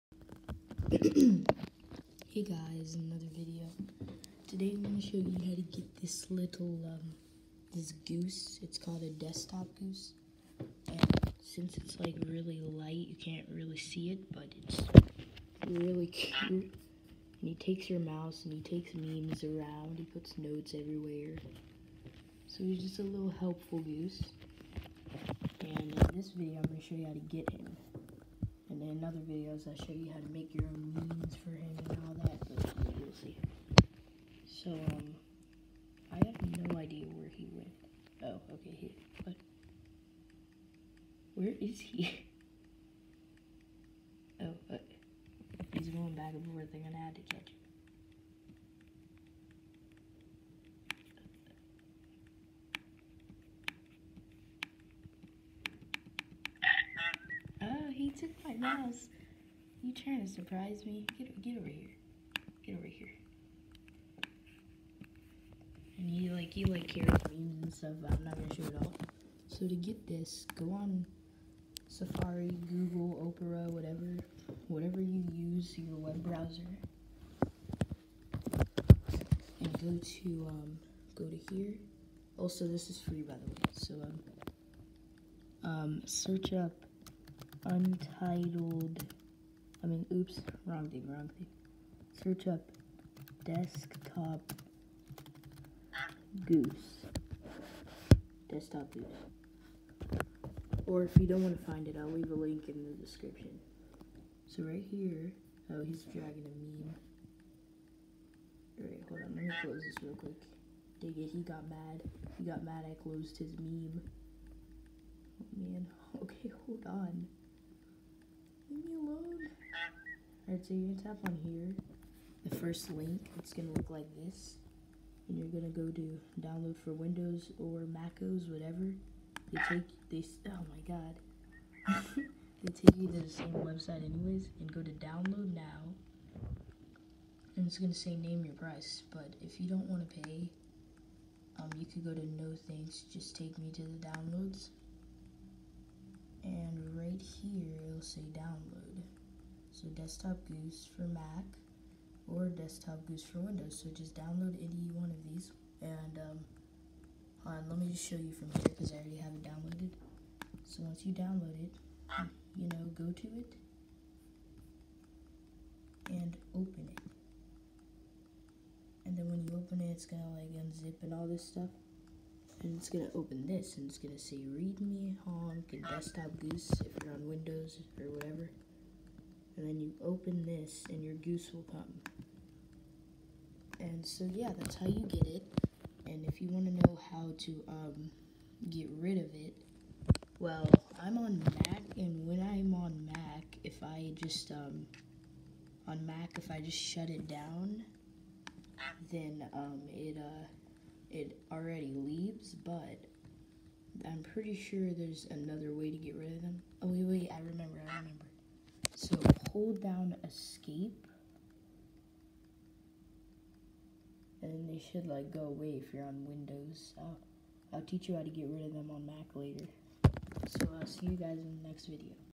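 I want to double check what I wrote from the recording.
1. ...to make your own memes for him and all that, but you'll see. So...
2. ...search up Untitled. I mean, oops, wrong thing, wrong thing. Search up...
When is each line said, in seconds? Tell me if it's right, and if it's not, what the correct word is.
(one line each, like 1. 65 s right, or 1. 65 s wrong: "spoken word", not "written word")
1. 30 s right
2. 86 s right.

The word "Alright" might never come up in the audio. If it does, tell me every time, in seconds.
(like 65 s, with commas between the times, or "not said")
108 s, 120 s.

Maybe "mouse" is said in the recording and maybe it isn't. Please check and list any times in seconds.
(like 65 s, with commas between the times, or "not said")
18 s, 58 s.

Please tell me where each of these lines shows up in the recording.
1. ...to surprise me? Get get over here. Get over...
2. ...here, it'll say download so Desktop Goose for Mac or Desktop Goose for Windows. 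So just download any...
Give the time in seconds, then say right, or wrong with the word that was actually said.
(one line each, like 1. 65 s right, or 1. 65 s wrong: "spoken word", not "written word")
1. 60 s right
2. 147 s right.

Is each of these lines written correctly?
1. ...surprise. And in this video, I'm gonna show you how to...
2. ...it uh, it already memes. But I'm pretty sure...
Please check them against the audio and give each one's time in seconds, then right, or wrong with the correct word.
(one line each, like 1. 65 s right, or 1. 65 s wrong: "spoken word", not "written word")
1. 23 s wrong: "goose", not "surprise"
2. 199 s wrong: "leaves", not "memes".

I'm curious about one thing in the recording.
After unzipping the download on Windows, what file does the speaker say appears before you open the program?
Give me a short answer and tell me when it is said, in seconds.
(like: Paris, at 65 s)
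Read me, at 174 s.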